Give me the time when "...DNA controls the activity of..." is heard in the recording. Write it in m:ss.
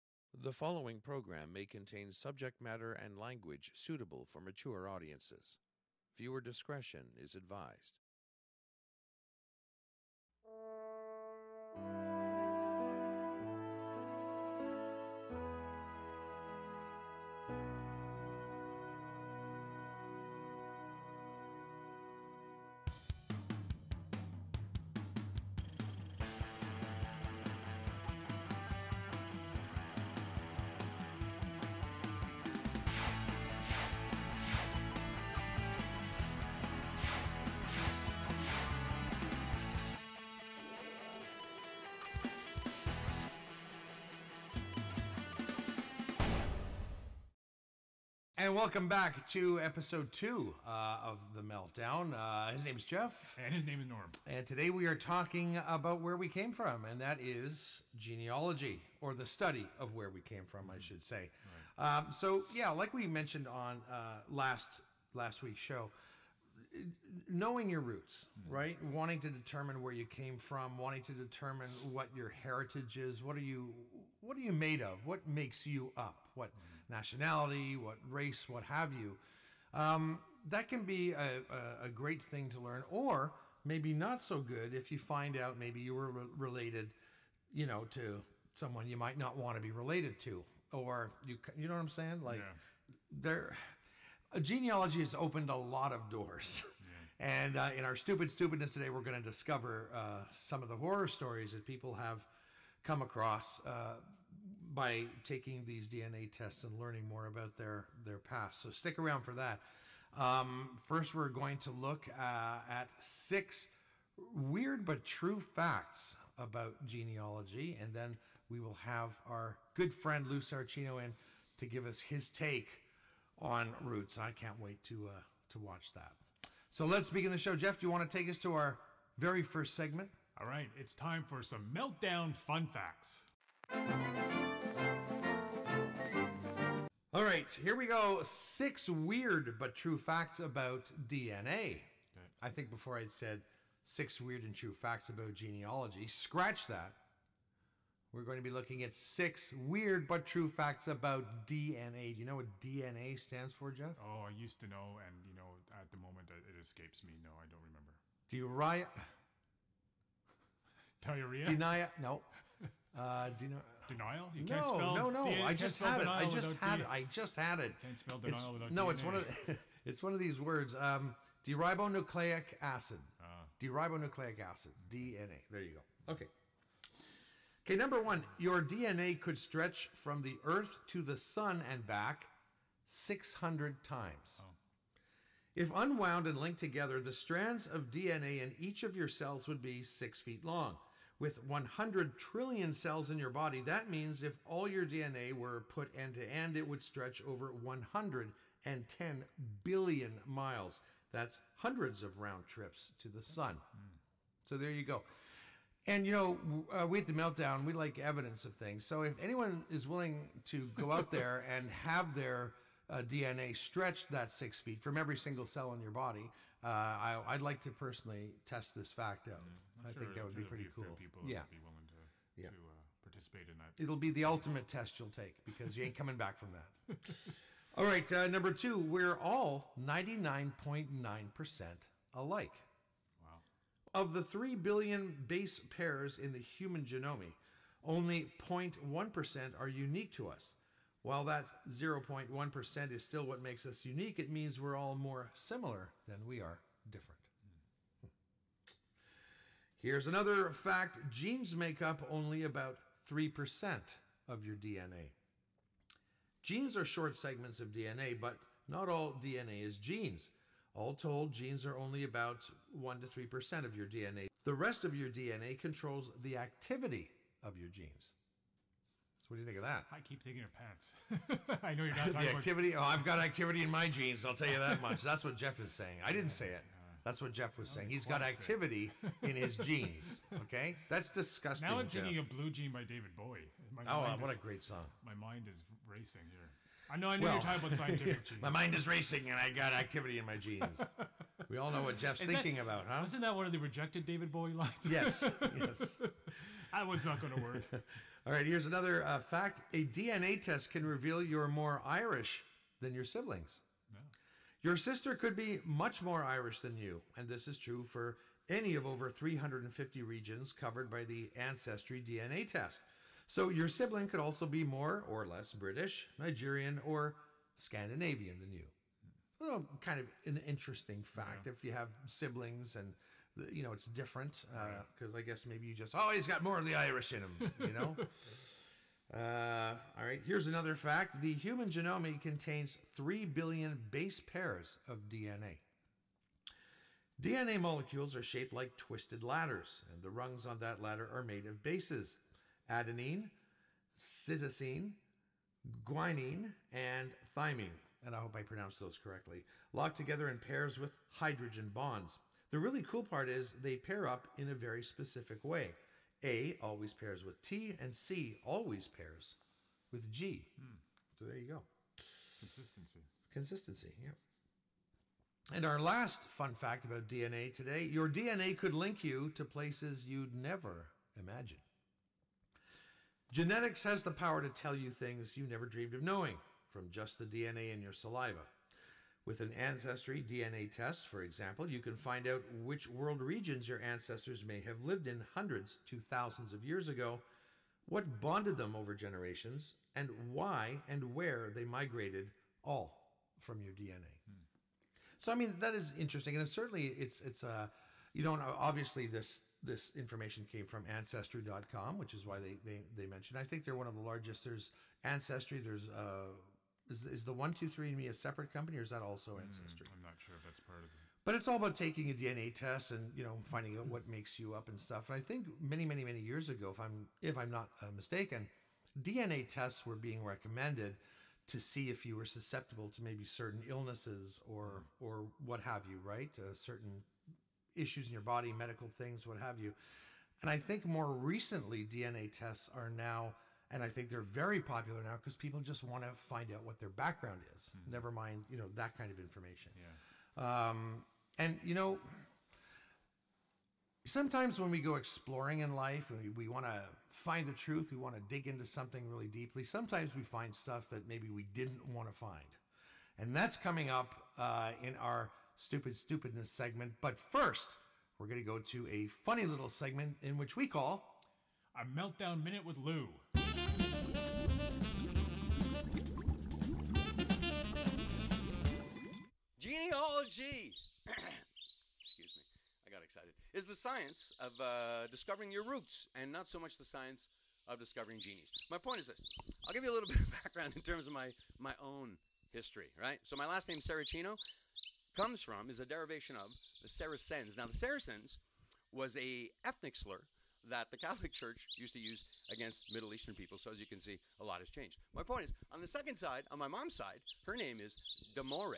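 4:25.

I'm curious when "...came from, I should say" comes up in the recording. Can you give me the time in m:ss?
1:00.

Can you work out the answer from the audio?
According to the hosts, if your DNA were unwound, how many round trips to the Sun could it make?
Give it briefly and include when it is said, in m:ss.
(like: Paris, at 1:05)
600, at 3:02.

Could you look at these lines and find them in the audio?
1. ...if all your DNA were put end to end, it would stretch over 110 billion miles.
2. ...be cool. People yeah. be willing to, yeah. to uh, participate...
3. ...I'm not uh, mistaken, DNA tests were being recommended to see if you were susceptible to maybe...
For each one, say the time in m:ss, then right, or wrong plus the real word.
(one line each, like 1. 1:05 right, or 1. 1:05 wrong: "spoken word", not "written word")
1. 3:14 right
2. 3:40 right
3. 6:57 right.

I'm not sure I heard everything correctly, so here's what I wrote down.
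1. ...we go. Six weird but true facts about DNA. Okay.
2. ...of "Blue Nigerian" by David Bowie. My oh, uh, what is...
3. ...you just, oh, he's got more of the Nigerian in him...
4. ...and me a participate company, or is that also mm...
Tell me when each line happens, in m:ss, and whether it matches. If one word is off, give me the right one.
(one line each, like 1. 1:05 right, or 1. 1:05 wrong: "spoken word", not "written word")
1. 2:17 right
2. 4:42 wrong: "Jean", not "Nigerian"
3. 5:25 wrong: "Irish", not "Nigerian"
4. 6:47 wrong: "separate", not "participate".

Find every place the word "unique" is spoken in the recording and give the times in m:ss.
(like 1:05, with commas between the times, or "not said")
3:59, 4:03.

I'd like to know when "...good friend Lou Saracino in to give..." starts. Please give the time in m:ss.
1:59.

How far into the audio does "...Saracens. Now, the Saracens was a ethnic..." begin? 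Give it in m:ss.
8:06.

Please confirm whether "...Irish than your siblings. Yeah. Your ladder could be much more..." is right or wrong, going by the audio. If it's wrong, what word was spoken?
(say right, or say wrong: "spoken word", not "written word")
wrong: "sister", not "ladder".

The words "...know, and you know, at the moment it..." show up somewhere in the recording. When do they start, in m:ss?
2:34.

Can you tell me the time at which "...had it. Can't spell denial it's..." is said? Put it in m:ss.
2:47.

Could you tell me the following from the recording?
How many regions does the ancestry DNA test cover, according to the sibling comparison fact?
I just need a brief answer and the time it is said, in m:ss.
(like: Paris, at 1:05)
350, at 5:09.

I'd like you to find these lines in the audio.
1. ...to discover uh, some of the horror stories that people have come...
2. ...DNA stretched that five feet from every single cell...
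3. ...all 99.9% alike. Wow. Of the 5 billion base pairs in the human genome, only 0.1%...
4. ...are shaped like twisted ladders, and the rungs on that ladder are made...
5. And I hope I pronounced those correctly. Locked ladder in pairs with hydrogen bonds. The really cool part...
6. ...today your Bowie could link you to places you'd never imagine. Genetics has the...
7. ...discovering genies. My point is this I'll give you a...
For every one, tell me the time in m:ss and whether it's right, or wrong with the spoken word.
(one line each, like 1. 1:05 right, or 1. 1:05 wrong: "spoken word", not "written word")
1. 1:39 right
2. 3:33 wrong: "six", not "five"
3. 3:49 wrong: "3", not "5"
4. 5:38 right
5. 5:48 wrong: "together", not "ladder"
6. 6:07 wrong: "DNA", not "Bowie"
7. 7:57 right.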